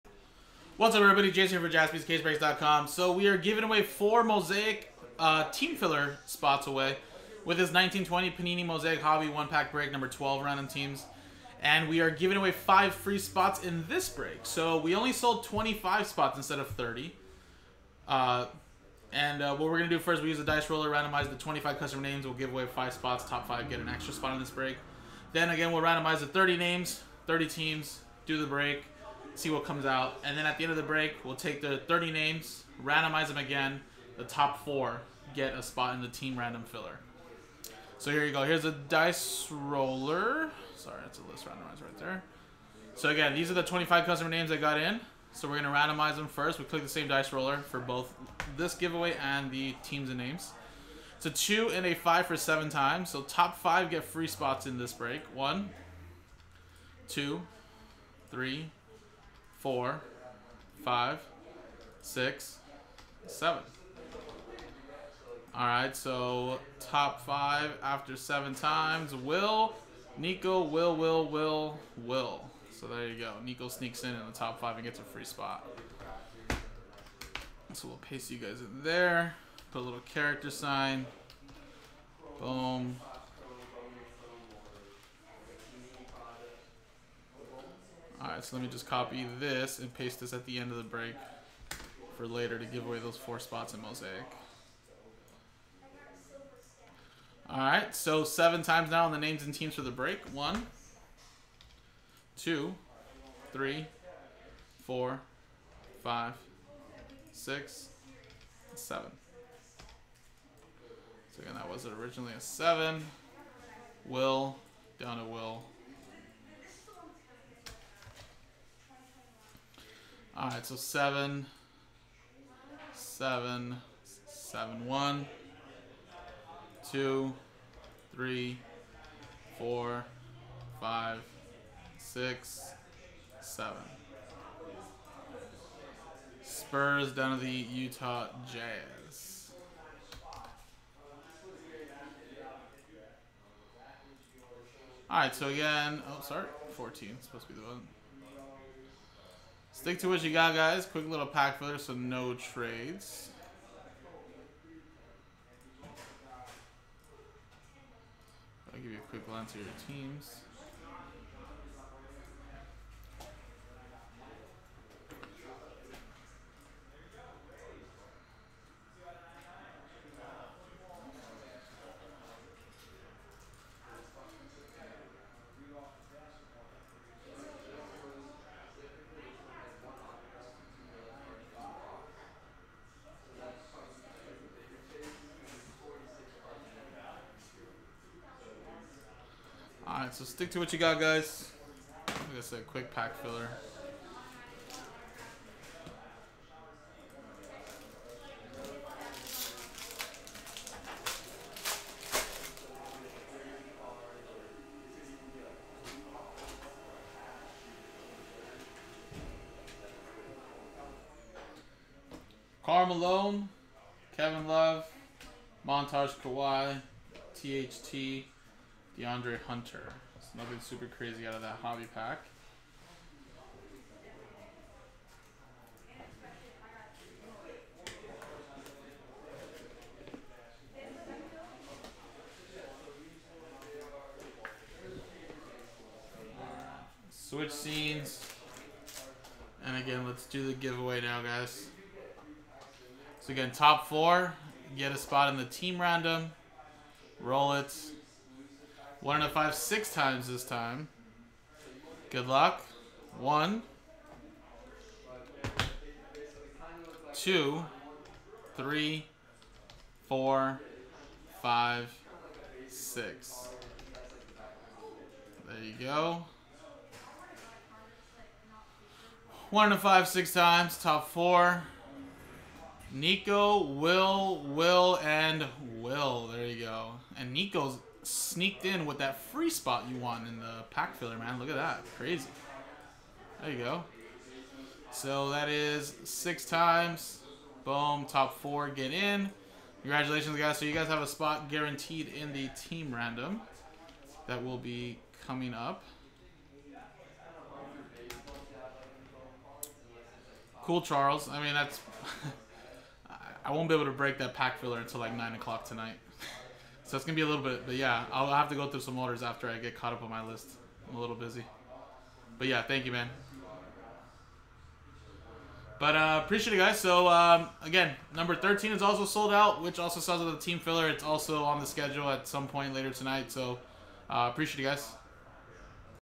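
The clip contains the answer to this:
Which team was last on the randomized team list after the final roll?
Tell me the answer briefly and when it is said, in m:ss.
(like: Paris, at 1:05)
Utah Jazz, at 2:17.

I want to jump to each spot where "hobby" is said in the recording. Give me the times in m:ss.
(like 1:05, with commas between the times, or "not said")
0:08, 3:41.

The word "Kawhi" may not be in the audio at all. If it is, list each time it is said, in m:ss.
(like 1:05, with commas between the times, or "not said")
3:36.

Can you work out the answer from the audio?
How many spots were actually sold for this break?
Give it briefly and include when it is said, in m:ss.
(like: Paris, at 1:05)
25, at 0:15.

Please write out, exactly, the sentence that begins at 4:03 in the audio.
So again, top four, get a spot in the team random, roll it, one and a five six times this time.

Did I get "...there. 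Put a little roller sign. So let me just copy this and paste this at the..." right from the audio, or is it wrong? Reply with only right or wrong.
wrong.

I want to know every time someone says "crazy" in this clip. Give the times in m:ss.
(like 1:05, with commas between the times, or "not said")
3:40, 4:41.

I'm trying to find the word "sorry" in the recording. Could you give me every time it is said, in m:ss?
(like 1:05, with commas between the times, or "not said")
0:40, 2:26.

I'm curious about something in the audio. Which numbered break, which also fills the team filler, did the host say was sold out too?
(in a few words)
13.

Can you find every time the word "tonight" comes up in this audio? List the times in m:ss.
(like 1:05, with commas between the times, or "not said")
5:05, 5:22.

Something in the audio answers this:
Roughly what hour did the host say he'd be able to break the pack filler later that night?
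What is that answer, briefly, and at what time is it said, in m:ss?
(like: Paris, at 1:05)
9 o'clock, at 5:05.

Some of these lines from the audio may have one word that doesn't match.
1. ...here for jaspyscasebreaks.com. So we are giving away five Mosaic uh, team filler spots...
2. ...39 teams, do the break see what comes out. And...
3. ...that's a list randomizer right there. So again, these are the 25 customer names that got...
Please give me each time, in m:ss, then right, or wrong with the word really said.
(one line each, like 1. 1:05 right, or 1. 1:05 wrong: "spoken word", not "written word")
1. 0:01 wrong: "four", not "five"
2. 0:27 wrong: "30", not "39"
3. 0:41 right.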